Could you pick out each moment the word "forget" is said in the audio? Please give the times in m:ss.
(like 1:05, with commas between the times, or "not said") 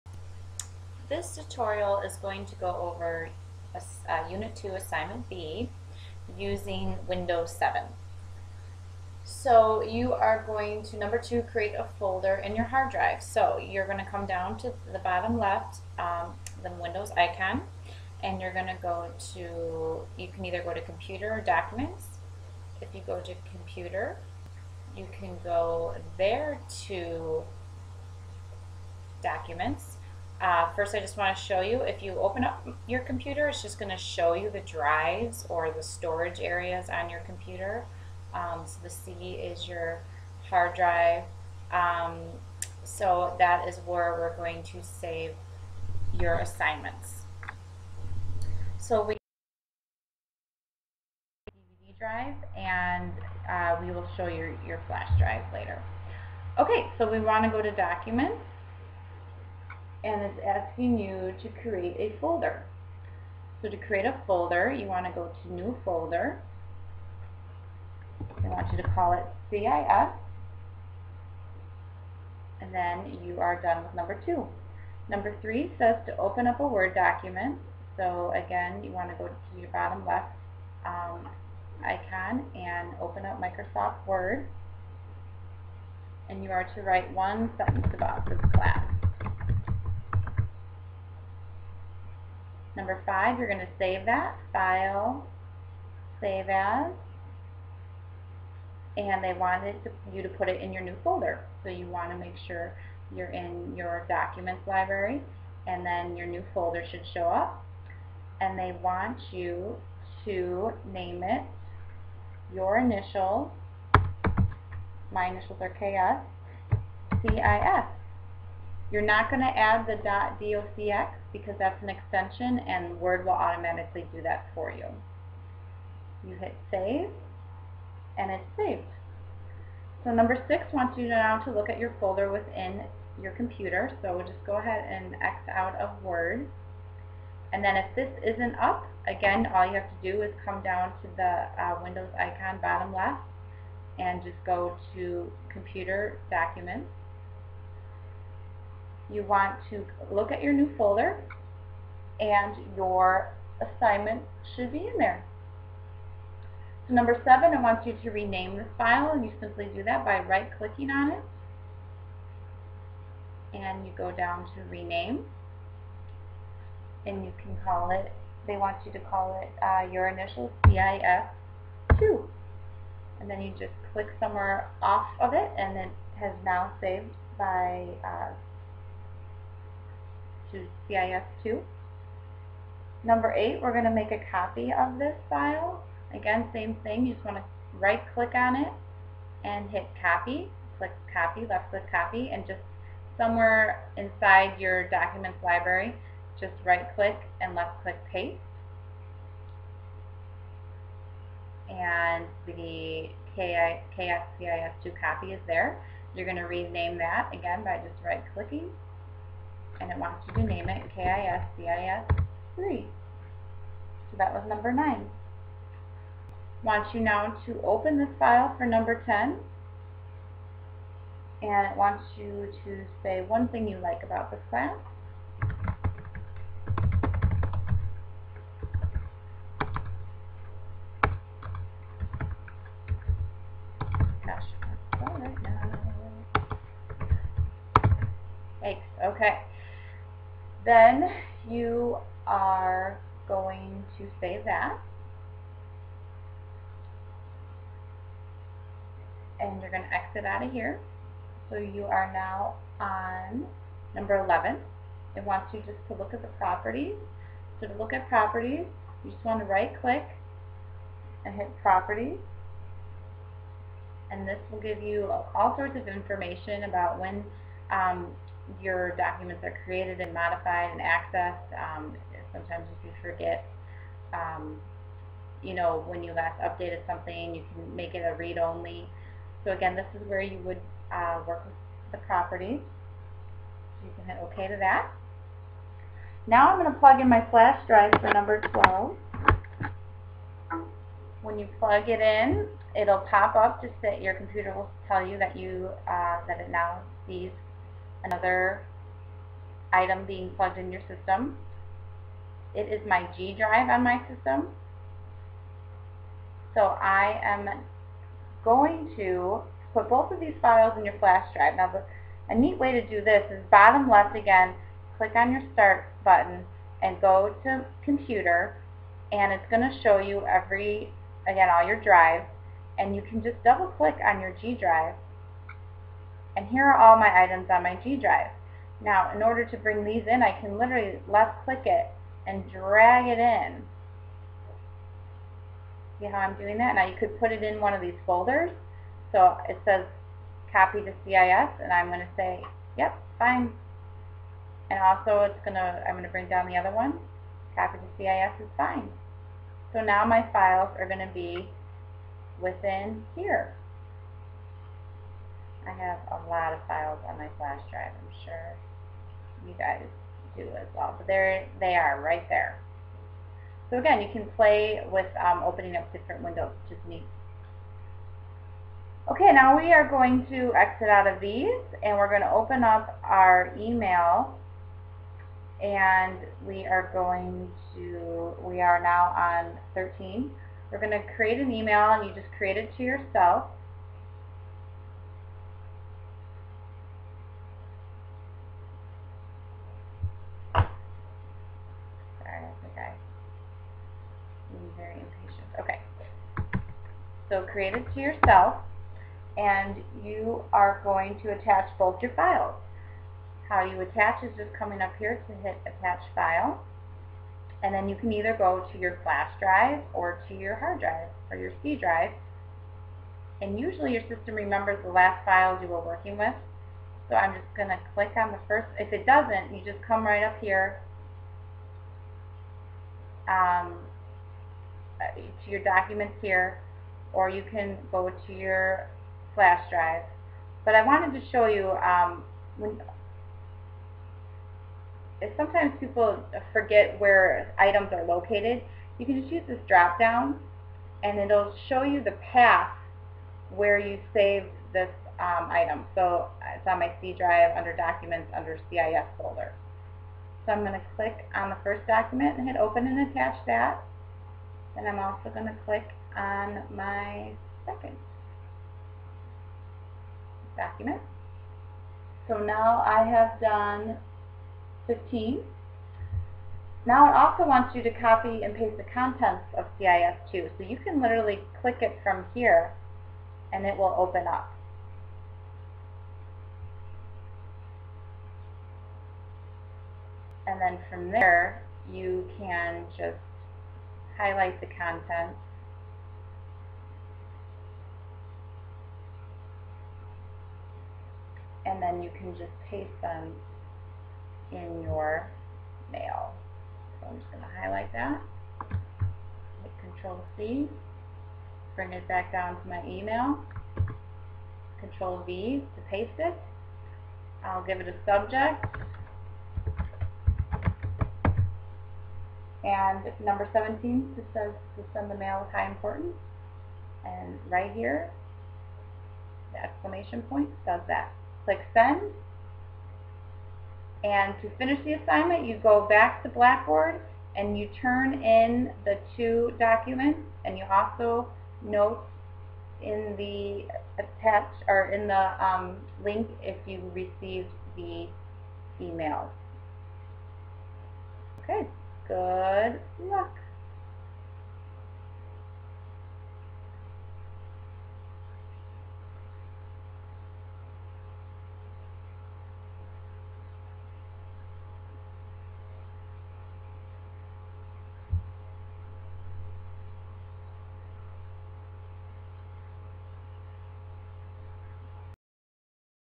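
4:33, 7:16.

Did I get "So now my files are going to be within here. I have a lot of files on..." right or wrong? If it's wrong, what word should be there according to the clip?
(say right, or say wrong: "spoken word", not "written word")
right.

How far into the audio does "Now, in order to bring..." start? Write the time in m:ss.
5:28.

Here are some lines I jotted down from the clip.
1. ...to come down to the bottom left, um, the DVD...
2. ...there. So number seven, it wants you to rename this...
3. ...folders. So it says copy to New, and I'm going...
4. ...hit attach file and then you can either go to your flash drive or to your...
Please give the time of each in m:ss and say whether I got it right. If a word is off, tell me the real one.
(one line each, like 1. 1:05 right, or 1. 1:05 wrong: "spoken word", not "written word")
1. 0:13 wrong: "Windows", not "DVD"
2. 2:34 right
3. 5:38 wrong: "CIS", not "New"
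4. 6:45 right.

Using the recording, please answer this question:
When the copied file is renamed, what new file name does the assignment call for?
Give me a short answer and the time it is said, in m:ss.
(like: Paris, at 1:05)
KSCIS3, at 3:30.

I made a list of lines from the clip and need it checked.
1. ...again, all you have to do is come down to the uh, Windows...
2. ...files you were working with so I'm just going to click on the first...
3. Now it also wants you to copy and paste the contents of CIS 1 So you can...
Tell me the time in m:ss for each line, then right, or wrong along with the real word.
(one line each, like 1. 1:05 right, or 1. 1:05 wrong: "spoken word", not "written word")
1. 2:19 right
2. 6:55 right
3. 7:46 wrong: "2", not "1".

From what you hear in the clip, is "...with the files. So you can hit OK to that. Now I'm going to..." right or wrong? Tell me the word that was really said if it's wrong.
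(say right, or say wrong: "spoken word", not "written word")
wrong: "properties", not "files".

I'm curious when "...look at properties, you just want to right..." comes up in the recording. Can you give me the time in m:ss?
4:17.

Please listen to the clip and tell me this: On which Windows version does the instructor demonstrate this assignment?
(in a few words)
Windows 7.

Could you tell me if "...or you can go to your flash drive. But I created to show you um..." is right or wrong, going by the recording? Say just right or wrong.
wrong.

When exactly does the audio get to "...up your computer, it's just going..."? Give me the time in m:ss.
0:32.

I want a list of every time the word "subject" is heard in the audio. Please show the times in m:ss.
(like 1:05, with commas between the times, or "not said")
8:28.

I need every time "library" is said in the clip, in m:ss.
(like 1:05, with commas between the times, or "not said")
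1:44, 3:15.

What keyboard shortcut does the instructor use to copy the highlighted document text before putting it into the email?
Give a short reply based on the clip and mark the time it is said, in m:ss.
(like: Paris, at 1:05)
Control C, at 8:19.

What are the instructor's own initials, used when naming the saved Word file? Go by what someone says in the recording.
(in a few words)
KS.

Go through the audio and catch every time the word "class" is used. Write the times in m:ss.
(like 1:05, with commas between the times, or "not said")
1:28, 3:44.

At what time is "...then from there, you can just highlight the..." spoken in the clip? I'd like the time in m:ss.
8:00.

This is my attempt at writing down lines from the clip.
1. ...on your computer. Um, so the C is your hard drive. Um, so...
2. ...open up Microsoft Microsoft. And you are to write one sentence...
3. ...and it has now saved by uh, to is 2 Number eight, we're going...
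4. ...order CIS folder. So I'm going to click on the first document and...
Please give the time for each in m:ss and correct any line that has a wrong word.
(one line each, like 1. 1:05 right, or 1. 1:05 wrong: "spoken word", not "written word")
1. 0:36 right
2. 1:22 wrong: "Word", not "Microsoft"
3. 2:55 right
4. 7:28 wrong: "under", not "order".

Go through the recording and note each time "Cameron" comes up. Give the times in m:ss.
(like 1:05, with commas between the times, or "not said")
not said.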